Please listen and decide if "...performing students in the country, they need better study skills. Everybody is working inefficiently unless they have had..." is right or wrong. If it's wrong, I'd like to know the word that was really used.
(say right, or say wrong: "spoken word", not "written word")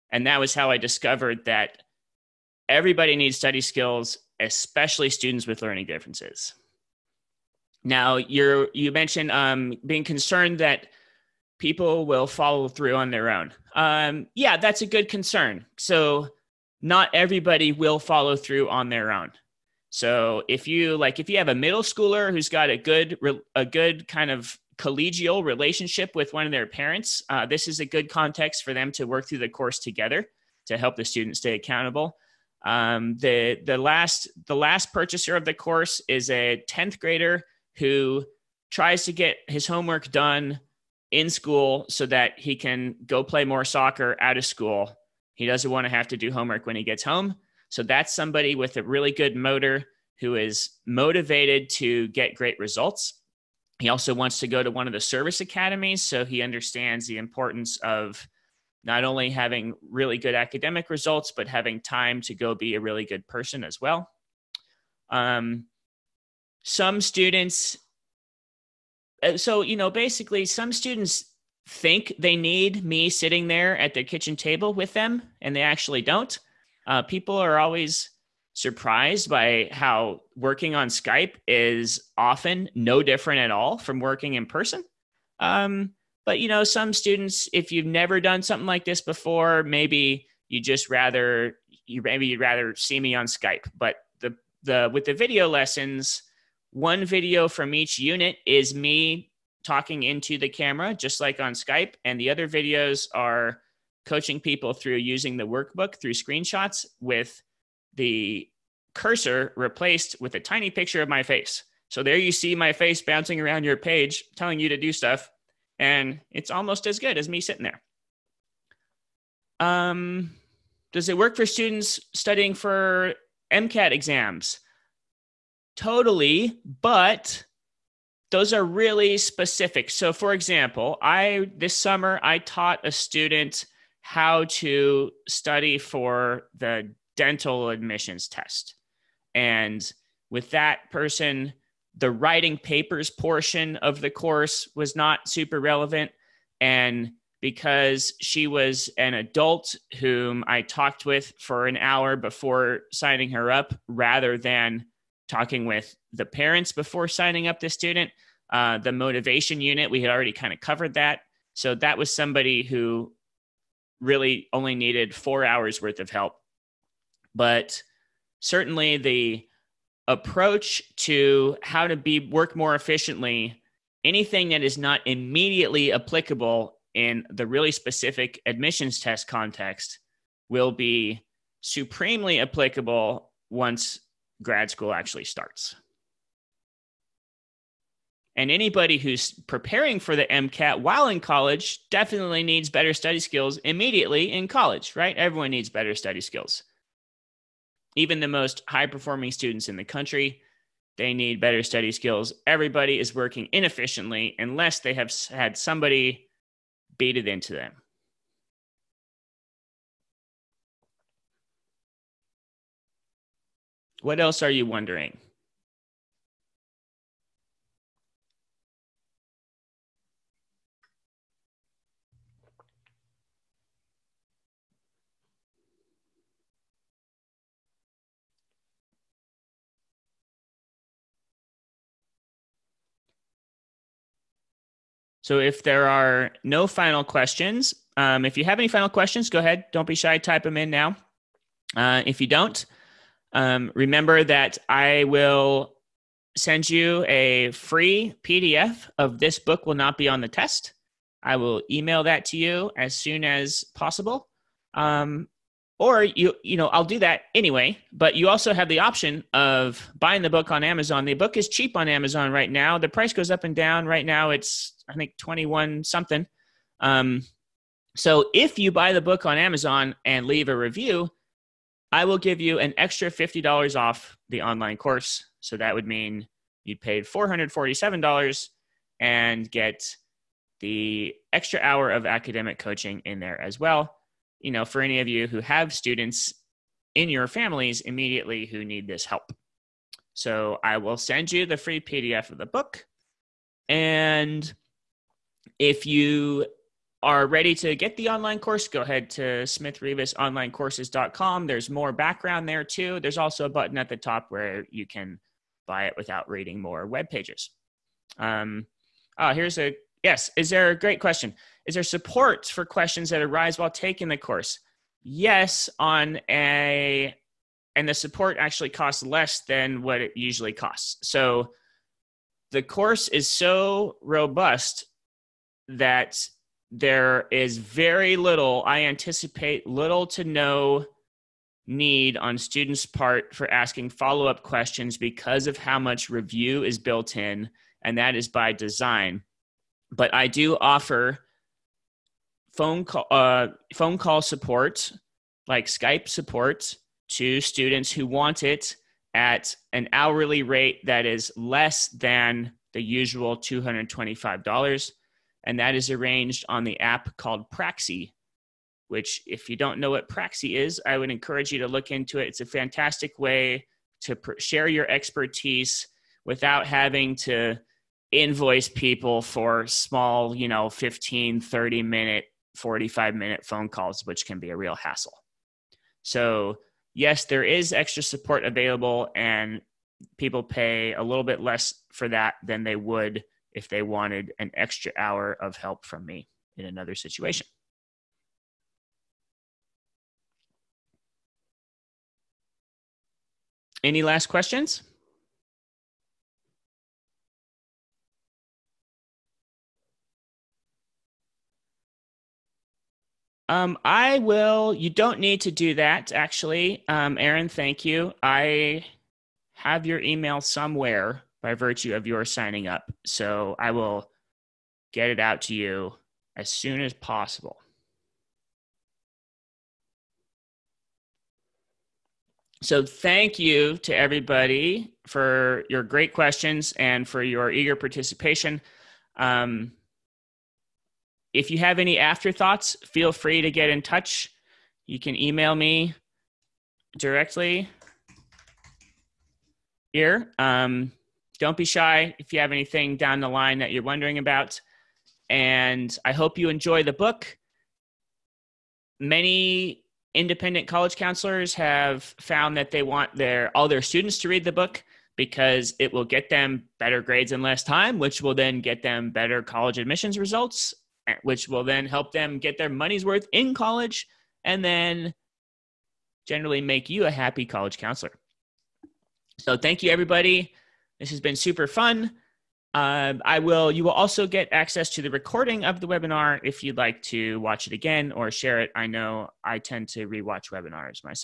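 right.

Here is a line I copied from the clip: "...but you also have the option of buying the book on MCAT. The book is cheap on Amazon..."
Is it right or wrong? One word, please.
wrong.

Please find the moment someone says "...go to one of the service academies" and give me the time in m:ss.
0:54.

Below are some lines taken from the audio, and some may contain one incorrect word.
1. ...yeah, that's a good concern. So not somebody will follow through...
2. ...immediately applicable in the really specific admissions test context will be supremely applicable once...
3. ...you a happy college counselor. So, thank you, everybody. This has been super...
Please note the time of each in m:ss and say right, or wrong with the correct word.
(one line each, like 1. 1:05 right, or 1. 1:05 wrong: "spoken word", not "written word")
1. 0:14 wrong: "everybody", not "somebody"
2. 2:55 right
3. 7:46 right.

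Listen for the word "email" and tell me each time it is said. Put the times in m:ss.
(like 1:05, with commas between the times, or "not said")
4:11, 6:49, 7:15.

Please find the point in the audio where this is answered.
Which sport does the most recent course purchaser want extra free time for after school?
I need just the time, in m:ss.
0:43.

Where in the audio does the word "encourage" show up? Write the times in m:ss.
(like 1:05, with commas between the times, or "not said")
6:01.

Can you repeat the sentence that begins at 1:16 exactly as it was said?
Uh, people are always surprised by how working on Skype is often no different at all from working in person.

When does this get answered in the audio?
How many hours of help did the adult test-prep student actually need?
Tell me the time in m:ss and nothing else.
2:45.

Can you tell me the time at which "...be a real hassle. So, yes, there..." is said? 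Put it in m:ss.
6:14.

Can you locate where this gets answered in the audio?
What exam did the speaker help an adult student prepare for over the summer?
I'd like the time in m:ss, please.
2:17.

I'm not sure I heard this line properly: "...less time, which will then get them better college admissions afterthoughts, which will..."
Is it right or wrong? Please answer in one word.
wrong.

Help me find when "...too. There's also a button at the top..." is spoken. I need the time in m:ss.
5:02.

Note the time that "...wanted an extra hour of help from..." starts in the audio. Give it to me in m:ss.
6:23.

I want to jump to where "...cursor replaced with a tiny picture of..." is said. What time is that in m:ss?
1:48.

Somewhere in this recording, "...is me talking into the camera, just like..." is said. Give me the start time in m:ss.
1:38.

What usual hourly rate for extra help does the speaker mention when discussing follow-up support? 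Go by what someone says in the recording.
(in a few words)
$225.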